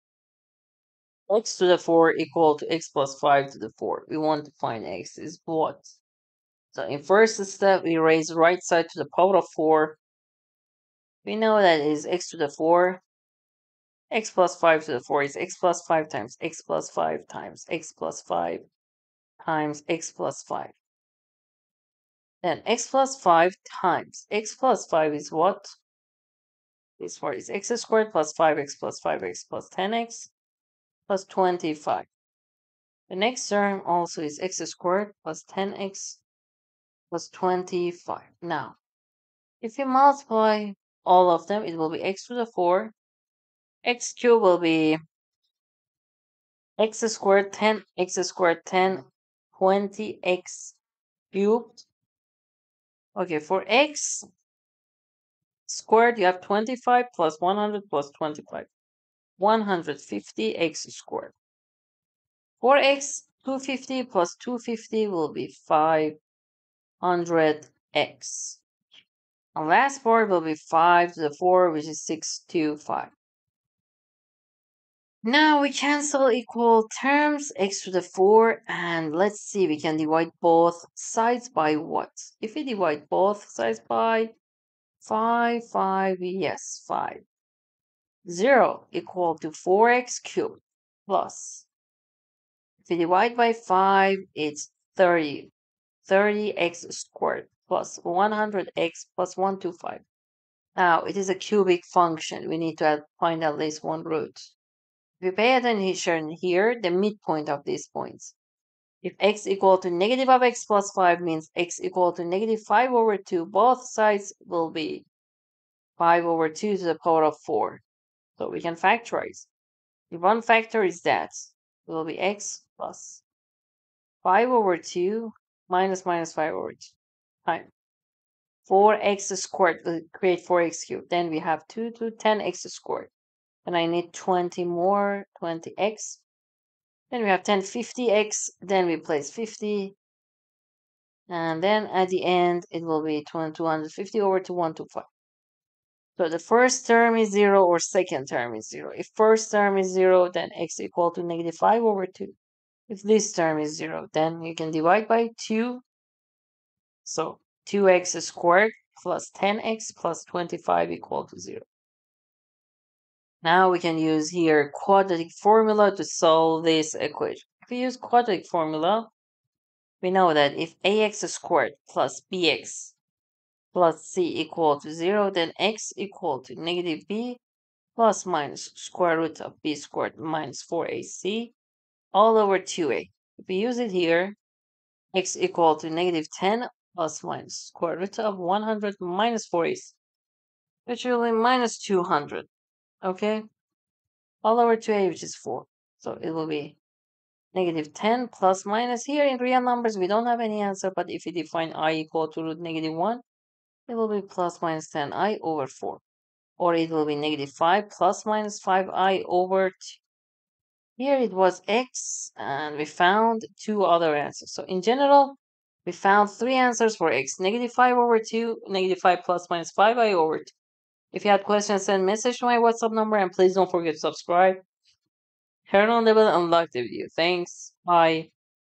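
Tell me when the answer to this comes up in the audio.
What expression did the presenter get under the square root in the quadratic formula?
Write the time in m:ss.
3:08.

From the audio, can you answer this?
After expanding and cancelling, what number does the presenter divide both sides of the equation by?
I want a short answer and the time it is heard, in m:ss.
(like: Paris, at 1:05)
5, at 1:22.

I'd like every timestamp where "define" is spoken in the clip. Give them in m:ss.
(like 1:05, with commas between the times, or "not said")
3:21.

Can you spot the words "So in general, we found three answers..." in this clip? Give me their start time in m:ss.
3:34.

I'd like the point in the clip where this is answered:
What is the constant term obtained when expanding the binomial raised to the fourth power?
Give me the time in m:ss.
1:12.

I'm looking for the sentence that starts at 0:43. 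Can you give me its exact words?
x cubed will be x squared 10, x squared 10, 20x cubed.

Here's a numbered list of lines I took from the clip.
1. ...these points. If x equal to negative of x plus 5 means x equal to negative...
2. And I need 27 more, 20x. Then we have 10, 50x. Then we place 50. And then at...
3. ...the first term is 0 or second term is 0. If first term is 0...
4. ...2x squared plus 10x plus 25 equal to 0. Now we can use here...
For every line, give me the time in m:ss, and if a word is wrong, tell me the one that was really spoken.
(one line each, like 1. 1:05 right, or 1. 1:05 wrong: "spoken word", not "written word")
1. 1:47 right
2. 2:13 wrong: "20", not "27"
3. 2:26 right
4. 2:37 right.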